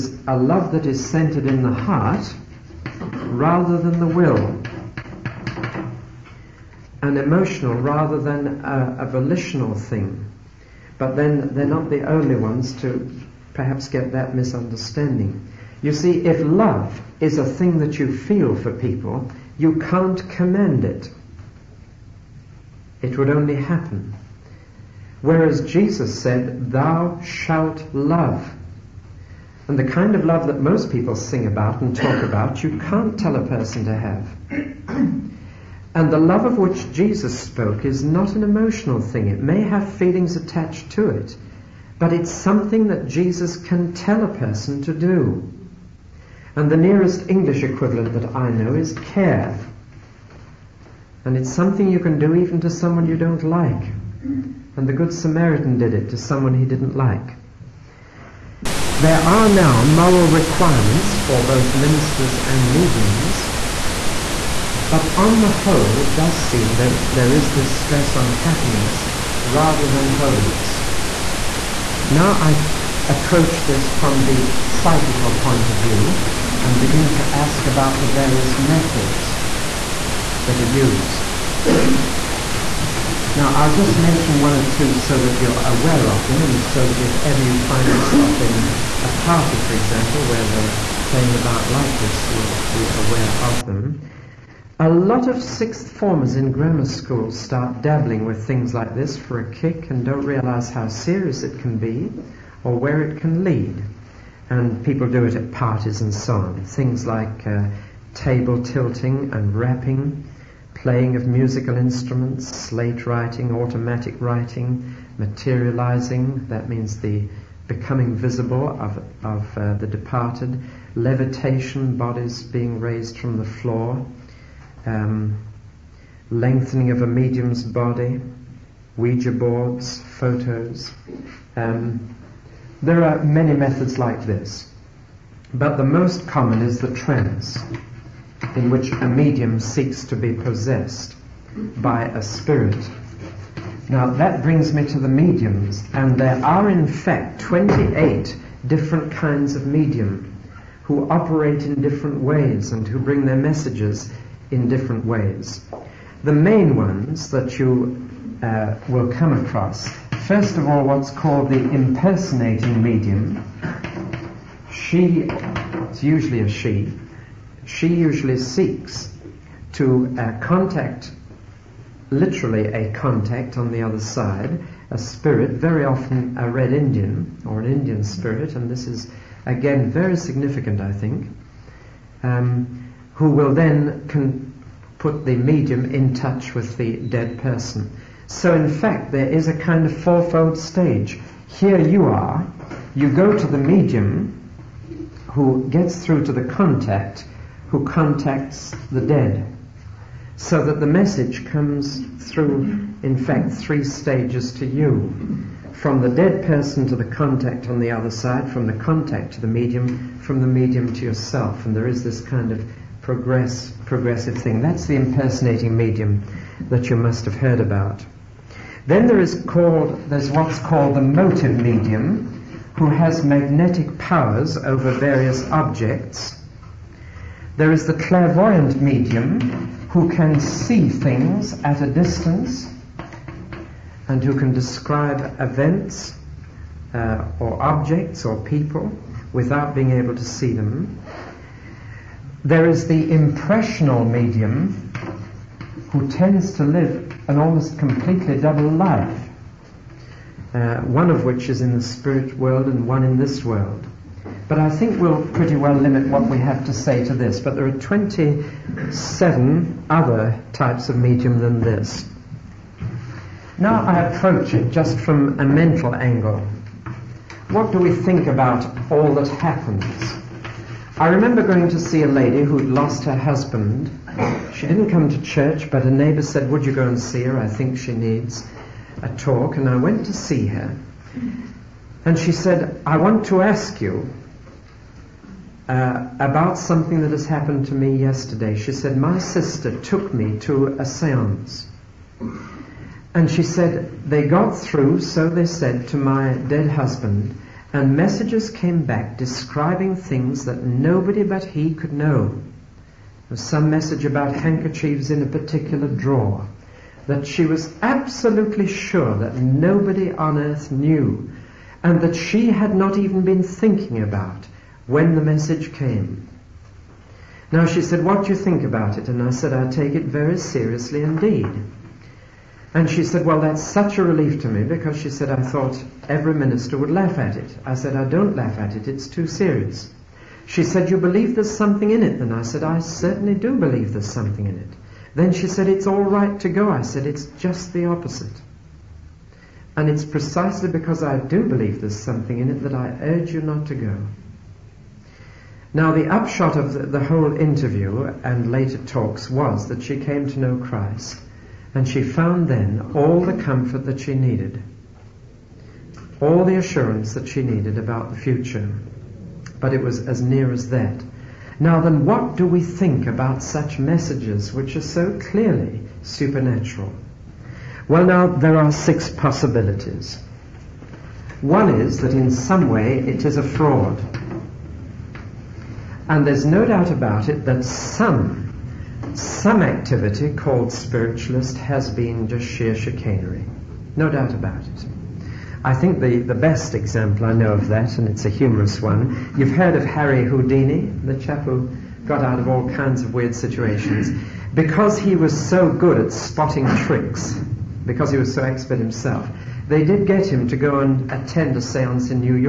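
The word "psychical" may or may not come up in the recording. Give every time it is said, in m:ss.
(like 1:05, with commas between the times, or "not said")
1:14.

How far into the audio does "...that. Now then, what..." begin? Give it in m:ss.
6:00.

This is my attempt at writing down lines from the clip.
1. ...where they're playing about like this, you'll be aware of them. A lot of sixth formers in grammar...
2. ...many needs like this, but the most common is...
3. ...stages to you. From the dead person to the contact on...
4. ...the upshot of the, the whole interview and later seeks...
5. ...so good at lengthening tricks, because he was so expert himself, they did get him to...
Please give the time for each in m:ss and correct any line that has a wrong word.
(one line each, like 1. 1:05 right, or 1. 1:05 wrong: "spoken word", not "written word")
1. 1:30 right
2. 2:13 wrong: "methods", not "needs"
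3. 3:23 right
4. 5:45 wrong: "talks", not "seeks"
5. 6:35 wrong: "spotting", not "lengthening".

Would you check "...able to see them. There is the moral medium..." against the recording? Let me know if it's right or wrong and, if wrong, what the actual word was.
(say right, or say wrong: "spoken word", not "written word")
wrong: "impressional", not "moral".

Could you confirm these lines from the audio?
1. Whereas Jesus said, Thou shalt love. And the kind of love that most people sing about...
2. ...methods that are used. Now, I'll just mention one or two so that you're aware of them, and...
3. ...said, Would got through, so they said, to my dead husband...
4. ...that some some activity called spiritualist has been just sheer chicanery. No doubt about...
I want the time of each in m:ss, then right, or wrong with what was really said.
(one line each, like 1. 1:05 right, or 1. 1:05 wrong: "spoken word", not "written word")
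1. 0:25 right
2. 1:18 right
3. 4:53 wrong: "They", not "Would"
4. 6:17 right.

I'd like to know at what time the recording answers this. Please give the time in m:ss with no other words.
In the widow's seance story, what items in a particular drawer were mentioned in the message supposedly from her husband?
5:04.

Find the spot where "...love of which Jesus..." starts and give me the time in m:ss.
0:36.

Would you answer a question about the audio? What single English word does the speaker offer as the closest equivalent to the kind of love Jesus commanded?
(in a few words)
care.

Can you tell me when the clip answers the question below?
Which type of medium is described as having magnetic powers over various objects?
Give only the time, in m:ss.
3:41.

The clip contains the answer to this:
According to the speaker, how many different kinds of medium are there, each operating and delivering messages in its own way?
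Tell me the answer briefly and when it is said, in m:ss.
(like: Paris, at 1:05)
28, at 2:27.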